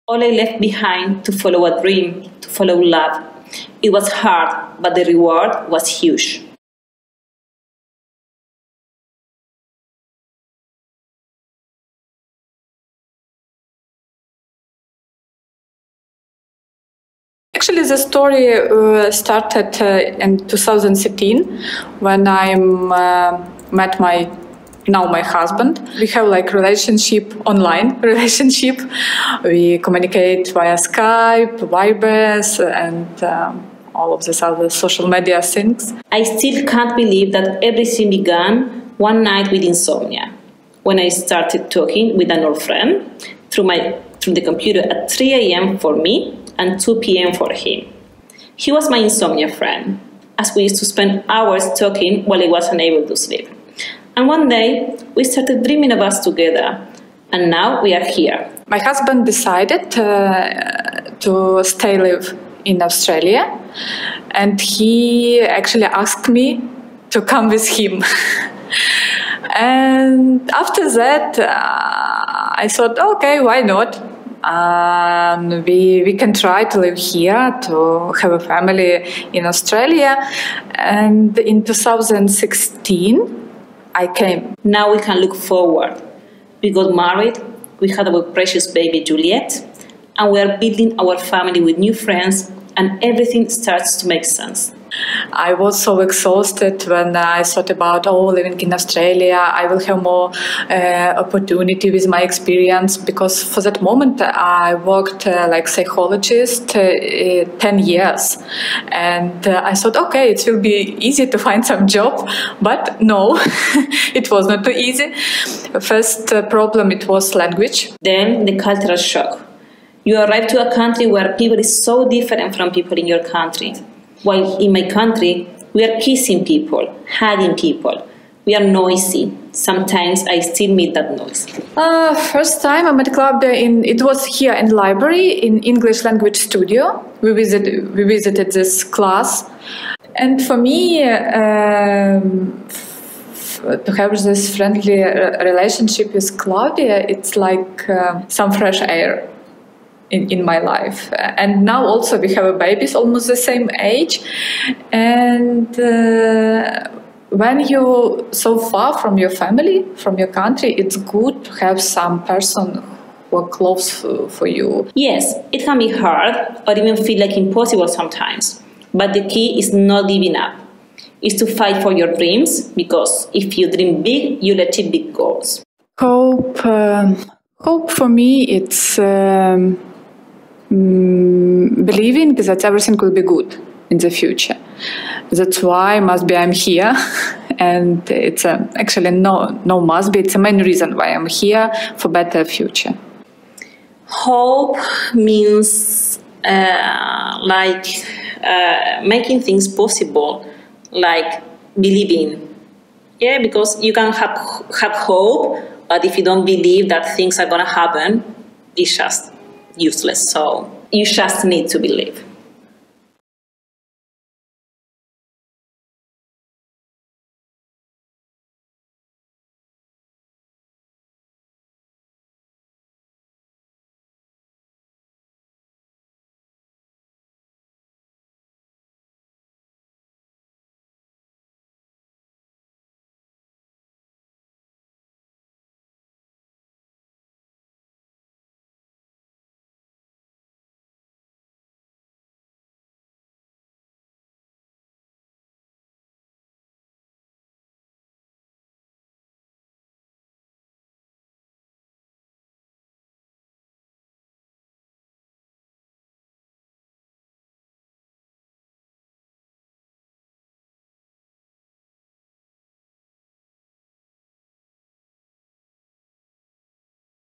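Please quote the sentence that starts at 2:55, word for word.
Hope, um, hope for me, it's.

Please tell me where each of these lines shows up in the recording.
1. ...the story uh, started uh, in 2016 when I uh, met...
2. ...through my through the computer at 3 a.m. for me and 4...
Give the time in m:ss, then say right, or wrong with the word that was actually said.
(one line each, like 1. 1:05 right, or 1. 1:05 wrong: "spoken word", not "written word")
1. 0:17 right
2. 0:43 wrong: "2", not "4".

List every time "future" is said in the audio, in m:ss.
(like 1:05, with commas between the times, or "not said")
3:04, 3:12.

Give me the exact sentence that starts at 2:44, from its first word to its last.
Yes, it can be hard or even feel like impossible sometimes.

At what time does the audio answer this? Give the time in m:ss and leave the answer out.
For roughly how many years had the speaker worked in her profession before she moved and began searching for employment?
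1:47.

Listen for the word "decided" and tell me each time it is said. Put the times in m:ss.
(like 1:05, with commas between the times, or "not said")
0:59.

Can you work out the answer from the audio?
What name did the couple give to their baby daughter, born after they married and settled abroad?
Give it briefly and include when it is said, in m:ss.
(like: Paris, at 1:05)
Juliet, at 1:29.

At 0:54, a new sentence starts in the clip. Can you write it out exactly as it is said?
And one day, we started dreaming of us together.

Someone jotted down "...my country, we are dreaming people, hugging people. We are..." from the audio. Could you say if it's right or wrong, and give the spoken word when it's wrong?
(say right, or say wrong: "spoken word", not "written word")
wrong: "kissing", not "dreaming".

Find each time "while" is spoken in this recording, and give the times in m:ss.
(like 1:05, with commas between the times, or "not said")
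0:52, 2:04.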